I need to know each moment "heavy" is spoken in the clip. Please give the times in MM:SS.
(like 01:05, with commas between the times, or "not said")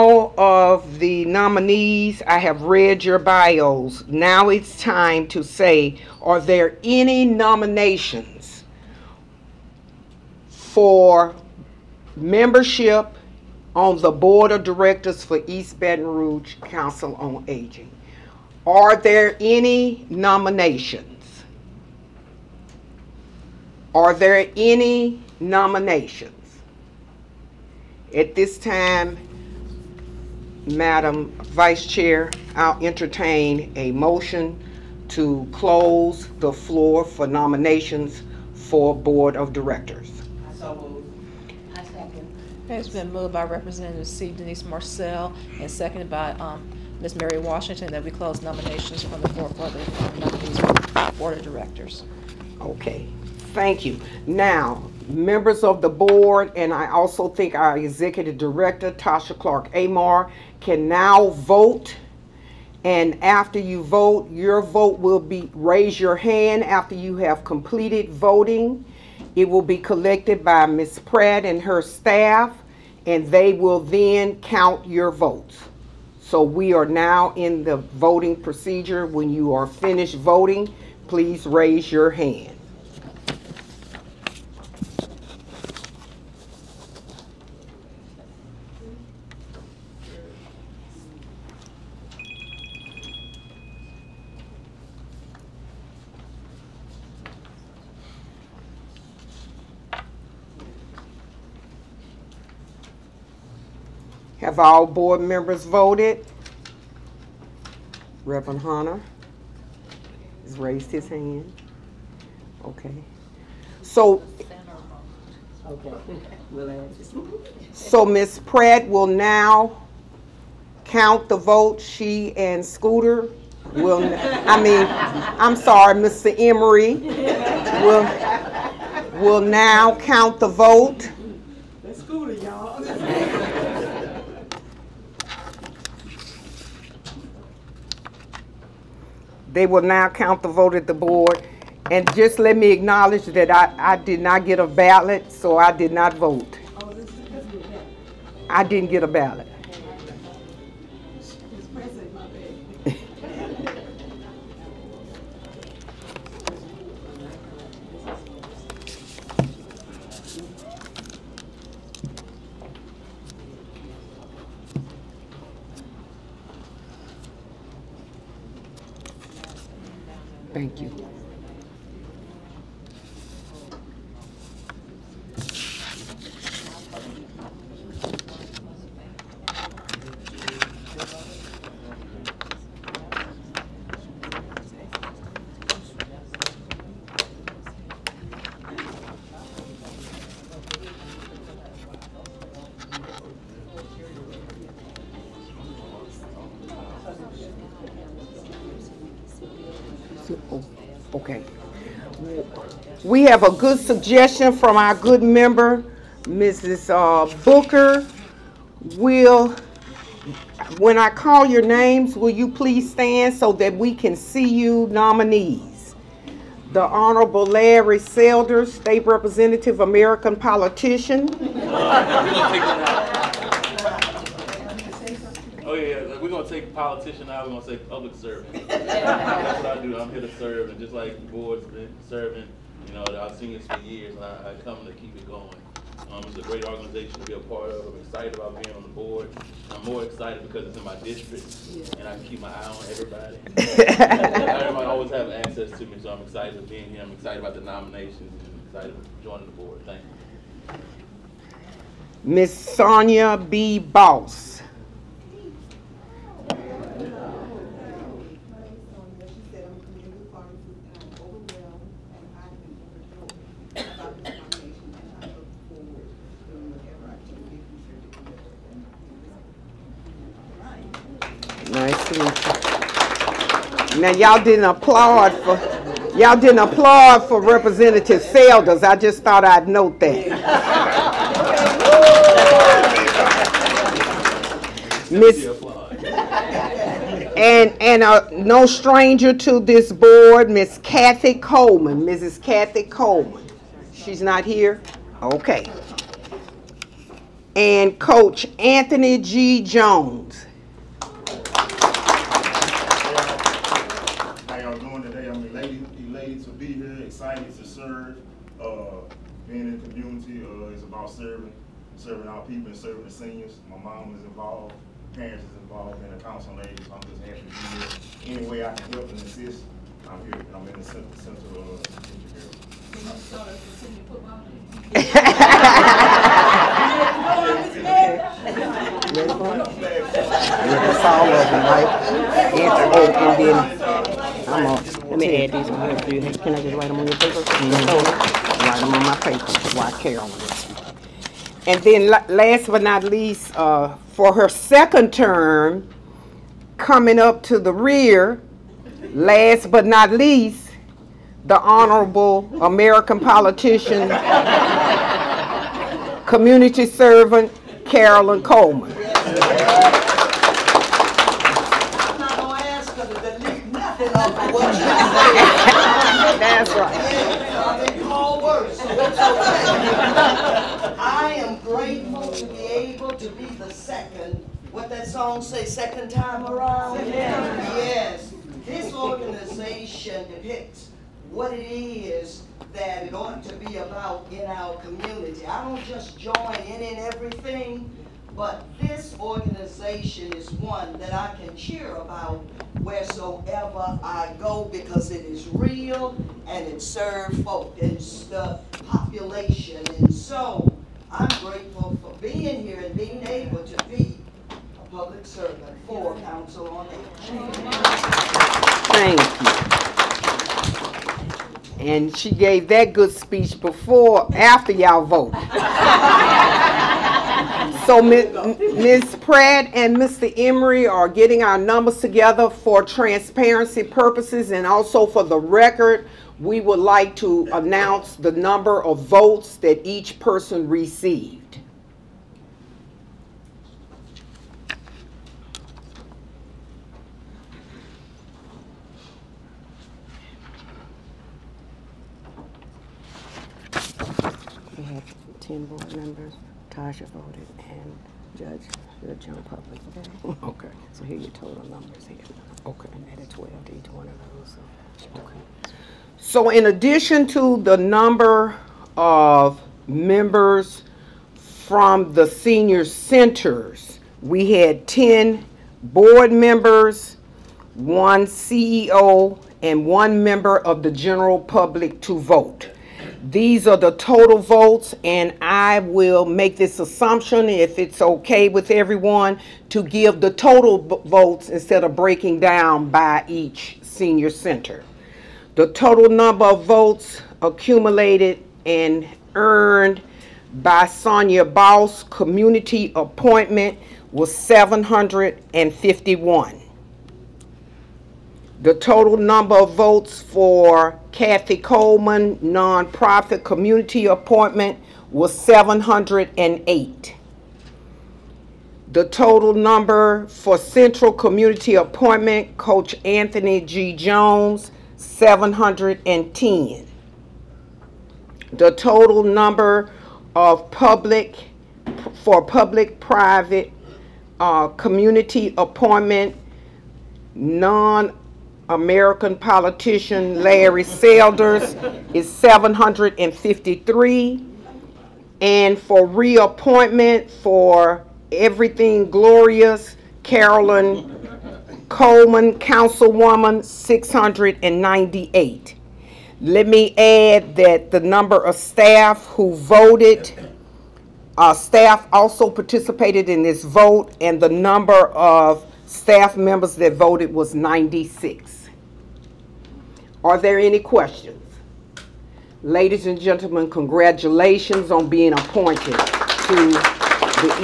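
not said.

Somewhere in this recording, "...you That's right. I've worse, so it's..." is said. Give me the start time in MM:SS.
06:04.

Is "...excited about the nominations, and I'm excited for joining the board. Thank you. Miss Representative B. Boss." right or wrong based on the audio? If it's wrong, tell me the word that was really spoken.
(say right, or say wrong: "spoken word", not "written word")
wrong: "Sonia", not "Representative".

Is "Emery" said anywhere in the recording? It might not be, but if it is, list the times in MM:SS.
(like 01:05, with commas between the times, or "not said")
02:06, 07:00.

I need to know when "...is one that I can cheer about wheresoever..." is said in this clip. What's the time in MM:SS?
06:30.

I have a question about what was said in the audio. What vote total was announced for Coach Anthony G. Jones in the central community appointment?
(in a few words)
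710.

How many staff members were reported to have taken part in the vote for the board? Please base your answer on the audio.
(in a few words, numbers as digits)
96.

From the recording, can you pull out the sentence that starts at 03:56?
Um, it's a great organization to be a part of.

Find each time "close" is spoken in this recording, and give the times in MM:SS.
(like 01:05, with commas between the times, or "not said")
00:35, 00:48.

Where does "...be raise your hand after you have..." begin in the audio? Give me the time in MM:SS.
01:05.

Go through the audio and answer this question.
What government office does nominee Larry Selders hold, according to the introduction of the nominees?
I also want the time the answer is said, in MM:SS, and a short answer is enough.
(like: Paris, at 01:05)
State Representative, at 03:38.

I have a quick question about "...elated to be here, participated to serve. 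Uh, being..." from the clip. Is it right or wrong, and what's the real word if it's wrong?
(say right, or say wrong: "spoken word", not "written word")
wrong: "excited", not "participated".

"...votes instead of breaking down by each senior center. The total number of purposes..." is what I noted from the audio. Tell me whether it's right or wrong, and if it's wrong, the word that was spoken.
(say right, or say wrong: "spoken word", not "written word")
wrong: "votes", not "purposes".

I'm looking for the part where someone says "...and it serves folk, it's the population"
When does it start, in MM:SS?
06:36.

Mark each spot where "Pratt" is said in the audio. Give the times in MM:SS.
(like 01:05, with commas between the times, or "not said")
01:11, 01:58, 06:59.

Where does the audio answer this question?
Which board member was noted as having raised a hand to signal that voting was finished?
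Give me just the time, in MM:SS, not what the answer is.
01:48.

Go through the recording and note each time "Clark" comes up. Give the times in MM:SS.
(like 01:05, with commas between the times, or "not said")
00:59.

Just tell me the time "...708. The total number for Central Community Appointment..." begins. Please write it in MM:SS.
08:25.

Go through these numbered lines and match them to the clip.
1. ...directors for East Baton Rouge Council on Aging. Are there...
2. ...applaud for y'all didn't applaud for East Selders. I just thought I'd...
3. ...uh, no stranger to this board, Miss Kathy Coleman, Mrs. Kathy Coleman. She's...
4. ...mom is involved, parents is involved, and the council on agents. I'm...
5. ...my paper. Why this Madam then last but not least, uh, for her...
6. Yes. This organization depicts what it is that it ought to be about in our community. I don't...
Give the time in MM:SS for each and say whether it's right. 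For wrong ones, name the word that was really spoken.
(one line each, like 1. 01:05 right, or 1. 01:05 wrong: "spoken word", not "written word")
1. 00:14 right
2. 04:34 wrong: "Representative", not "East"
3. 04:48 right
4. 05:13 right
5. 05:39 wrong: "And", not "Madam"
6. 06:17 right.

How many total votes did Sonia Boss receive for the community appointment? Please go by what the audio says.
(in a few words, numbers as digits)
751.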